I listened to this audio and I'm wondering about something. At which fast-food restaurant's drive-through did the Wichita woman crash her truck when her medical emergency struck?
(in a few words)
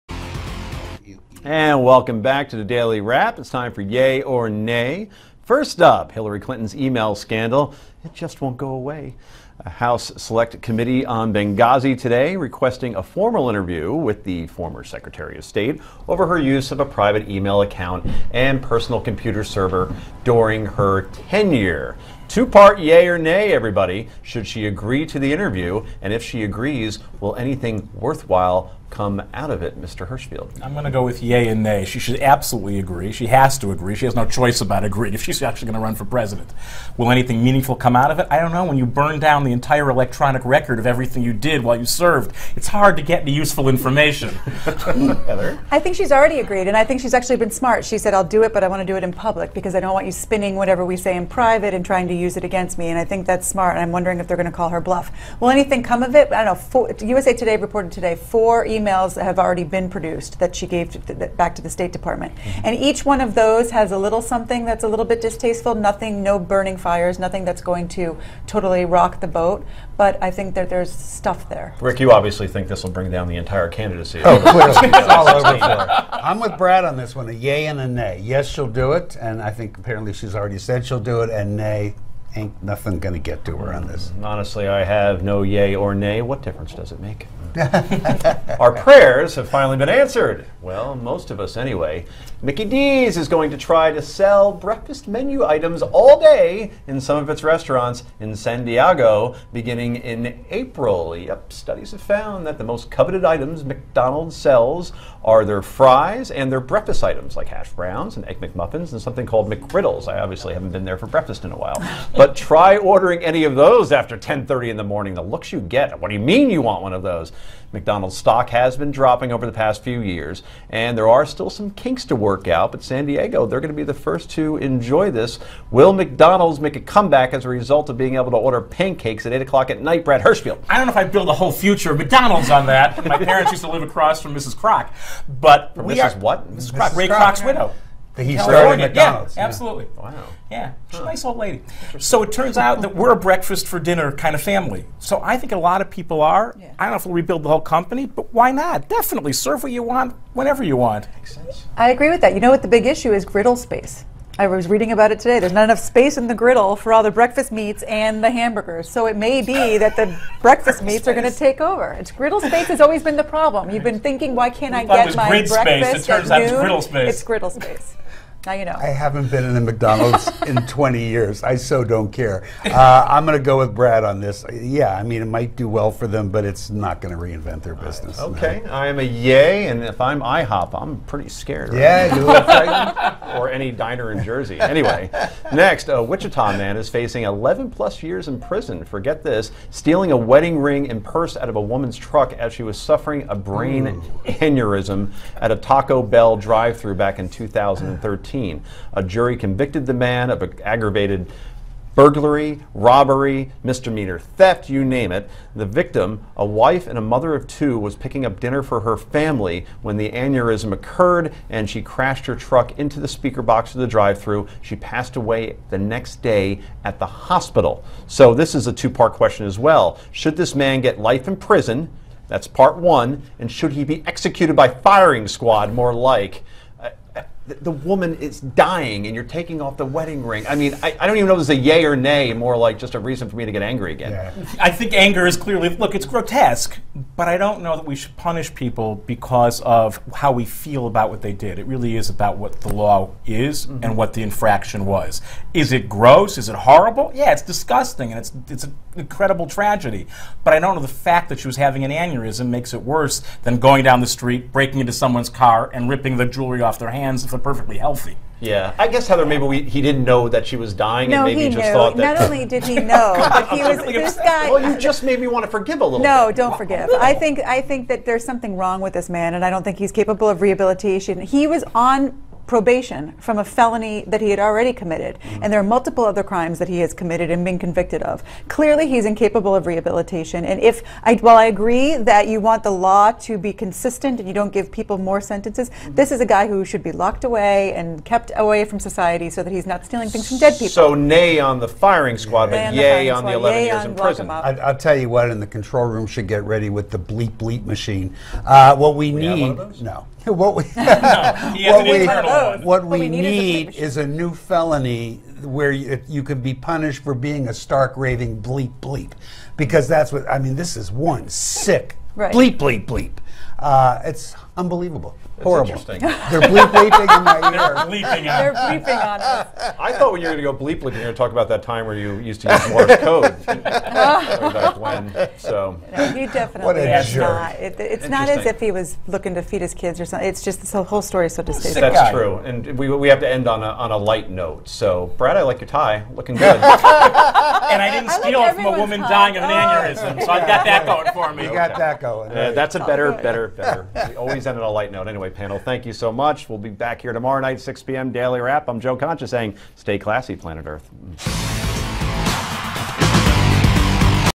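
Taco Bell.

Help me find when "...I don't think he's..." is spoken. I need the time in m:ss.
4:29.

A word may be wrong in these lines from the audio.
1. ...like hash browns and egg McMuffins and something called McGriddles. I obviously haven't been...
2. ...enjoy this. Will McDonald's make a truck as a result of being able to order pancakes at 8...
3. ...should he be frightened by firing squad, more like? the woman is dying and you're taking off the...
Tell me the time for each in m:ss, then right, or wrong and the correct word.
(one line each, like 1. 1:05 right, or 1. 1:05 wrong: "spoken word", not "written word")
1. 1:47 right
2. 2:04 wrong: "comeback", not "truck"
3. 3:43 wrong: "executed", not "frightened".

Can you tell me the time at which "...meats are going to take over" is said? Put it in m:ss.
2:40.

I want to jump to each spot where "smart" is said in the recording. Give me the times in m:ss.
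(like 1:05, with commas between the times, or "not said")
0:47, 0:53.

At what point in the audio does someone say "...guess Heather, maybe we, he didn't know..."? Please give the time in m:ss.
4:18.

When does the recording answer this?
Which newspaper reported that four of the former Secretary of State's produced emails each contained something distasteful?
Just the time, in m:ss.
0:57.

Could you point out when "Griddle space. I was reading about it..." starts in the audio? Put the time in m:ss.
2:33.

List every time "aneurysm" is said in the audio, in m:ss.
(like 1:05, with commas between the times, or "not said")
3:14, 3:30, 4:11, 5:39.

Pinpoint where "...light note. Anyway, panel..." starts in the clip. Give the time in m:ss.
5:44.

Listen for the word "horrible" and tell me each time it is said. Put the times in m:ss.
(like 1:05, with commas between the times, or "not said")
4:06, 5:15.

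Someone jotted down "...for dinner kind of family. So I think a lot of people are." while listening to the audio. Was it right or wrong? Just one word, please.
right.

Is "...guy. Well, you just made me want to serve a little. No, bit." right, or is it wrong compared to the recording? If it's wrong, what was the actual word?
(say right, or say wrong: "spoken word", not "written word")
wrong: "forgive", not "serve".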